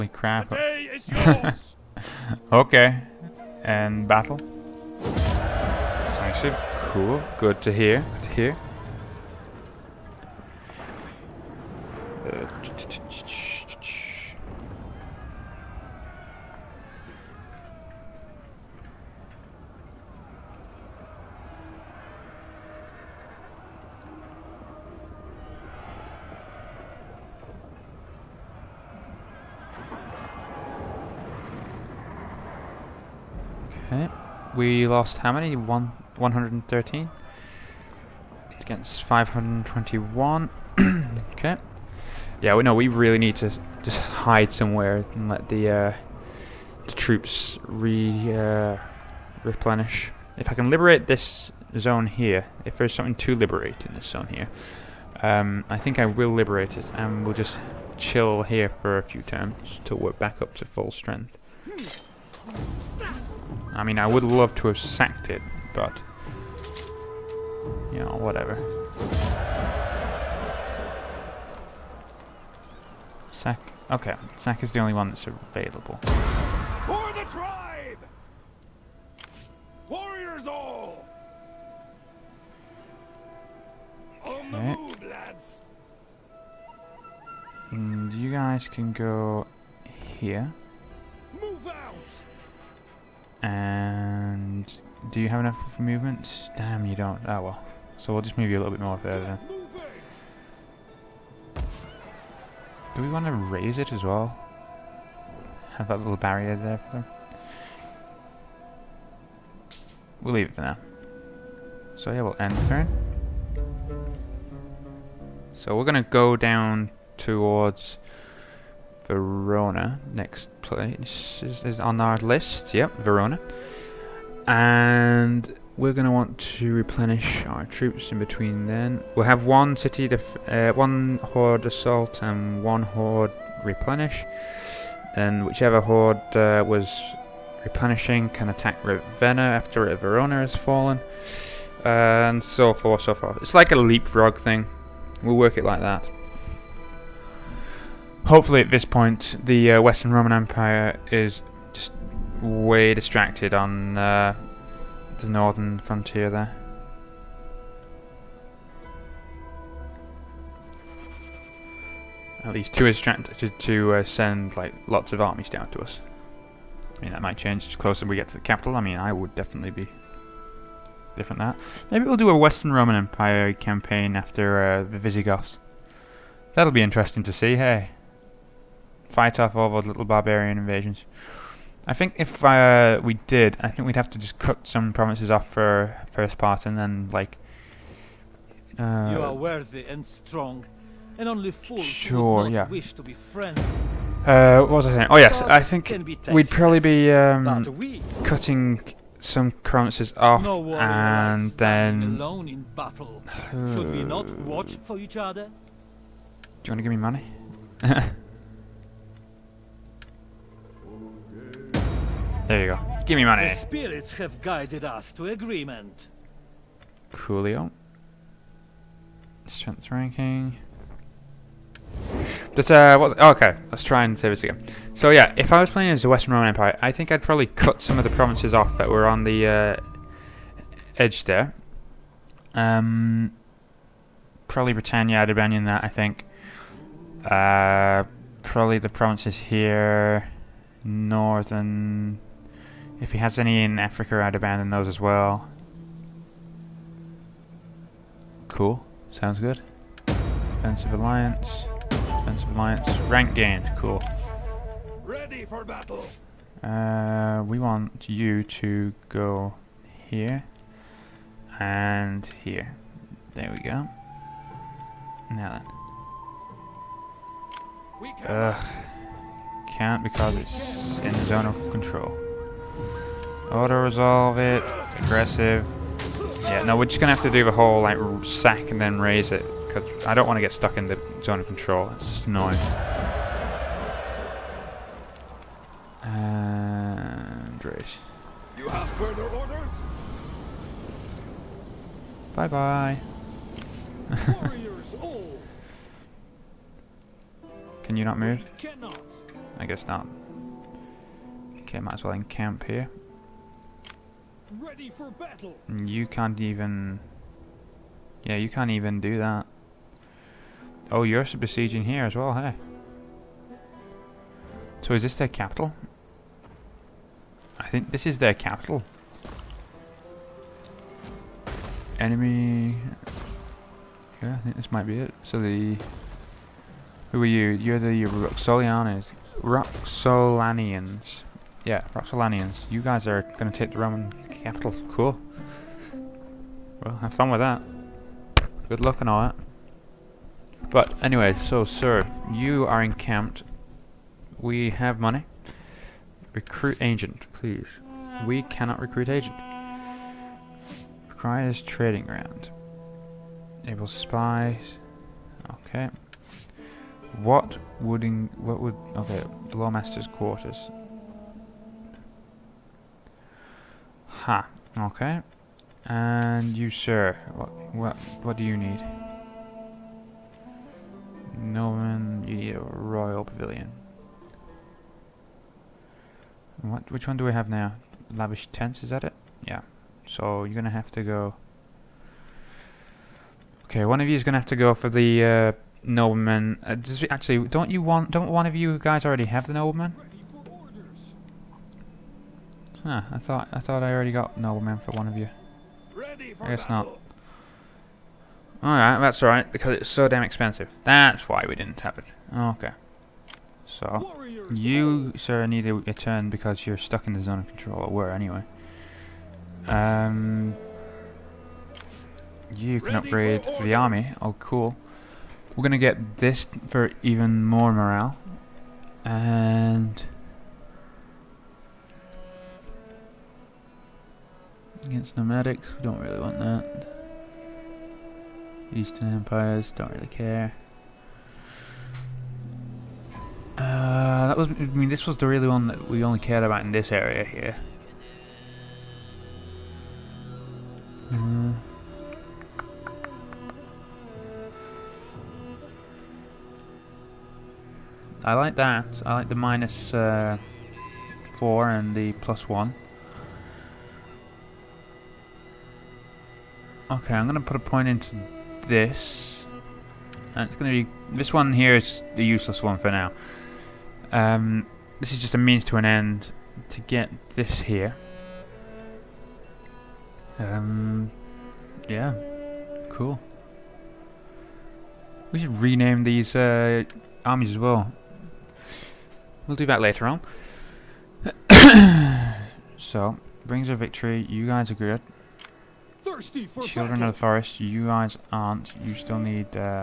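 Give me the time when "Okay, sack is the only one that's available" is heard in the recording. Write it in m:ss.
1:13.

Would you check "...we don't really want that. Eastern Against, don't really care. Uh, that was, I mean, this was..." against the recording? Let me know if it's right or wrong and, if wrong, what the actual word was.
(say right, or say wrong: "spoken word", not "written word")
wrong: "Empires", not "Against".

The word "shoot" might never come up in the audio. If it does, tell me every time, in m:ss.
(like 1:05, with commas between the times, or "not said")
not said.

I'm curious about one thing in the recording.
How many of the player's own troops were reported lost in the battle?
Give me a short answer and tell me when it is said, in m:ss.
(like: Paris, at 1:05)
113, at 0:36.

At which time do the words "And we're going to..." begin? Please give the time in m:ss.
2:04.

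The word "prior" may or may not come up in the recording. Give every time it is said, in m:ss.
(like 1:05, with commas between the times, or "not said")
not said.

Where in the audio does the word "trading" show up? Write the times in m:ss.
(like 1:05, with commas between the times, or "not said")
5:51.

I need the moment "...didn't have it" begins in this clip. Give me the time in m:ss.
6:41.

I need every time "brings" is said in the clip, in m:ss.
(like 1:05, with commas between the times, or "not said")
8:03.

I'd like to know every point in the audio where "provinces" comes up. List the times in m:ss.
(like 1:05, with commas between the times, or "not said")
3:04, 3:19, 3:48, 3:58.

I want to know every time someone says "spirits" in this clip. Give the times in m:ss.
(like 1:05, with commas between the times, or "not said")
3:33.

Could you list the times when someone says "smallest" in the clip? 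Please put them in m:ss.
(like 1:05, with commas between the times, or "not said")
not said.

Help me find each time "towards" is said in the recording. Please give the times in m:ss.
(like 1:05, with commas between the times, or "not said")
1:57.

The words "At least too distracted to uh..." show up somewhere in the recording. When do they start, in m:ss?
2:42.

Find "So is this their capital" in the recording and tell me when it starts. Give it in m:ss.
5:14.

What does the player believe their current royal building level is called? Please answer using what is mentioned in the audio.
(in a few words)
Lavish tents.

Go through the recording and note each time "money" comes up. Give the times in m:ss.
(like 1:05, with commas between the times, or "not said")
3:26, 3:33, 5:44.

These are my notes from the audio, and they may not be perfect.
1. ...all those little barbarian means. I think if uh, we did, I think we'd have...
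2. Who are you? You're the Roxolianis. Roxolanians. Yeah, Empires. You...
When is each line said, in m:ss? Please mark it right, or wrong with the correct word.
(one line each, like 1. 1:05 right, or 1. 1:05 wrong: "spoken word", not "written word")
1. 2:59 wrong: "invasions", not "means"
2. 5:27 wrong: "Roxolanians", not "Empires".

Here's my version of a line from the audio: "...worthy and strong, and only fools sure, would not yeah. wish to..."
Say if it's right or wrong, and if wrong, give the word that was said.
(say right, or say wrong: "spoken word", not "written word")
right.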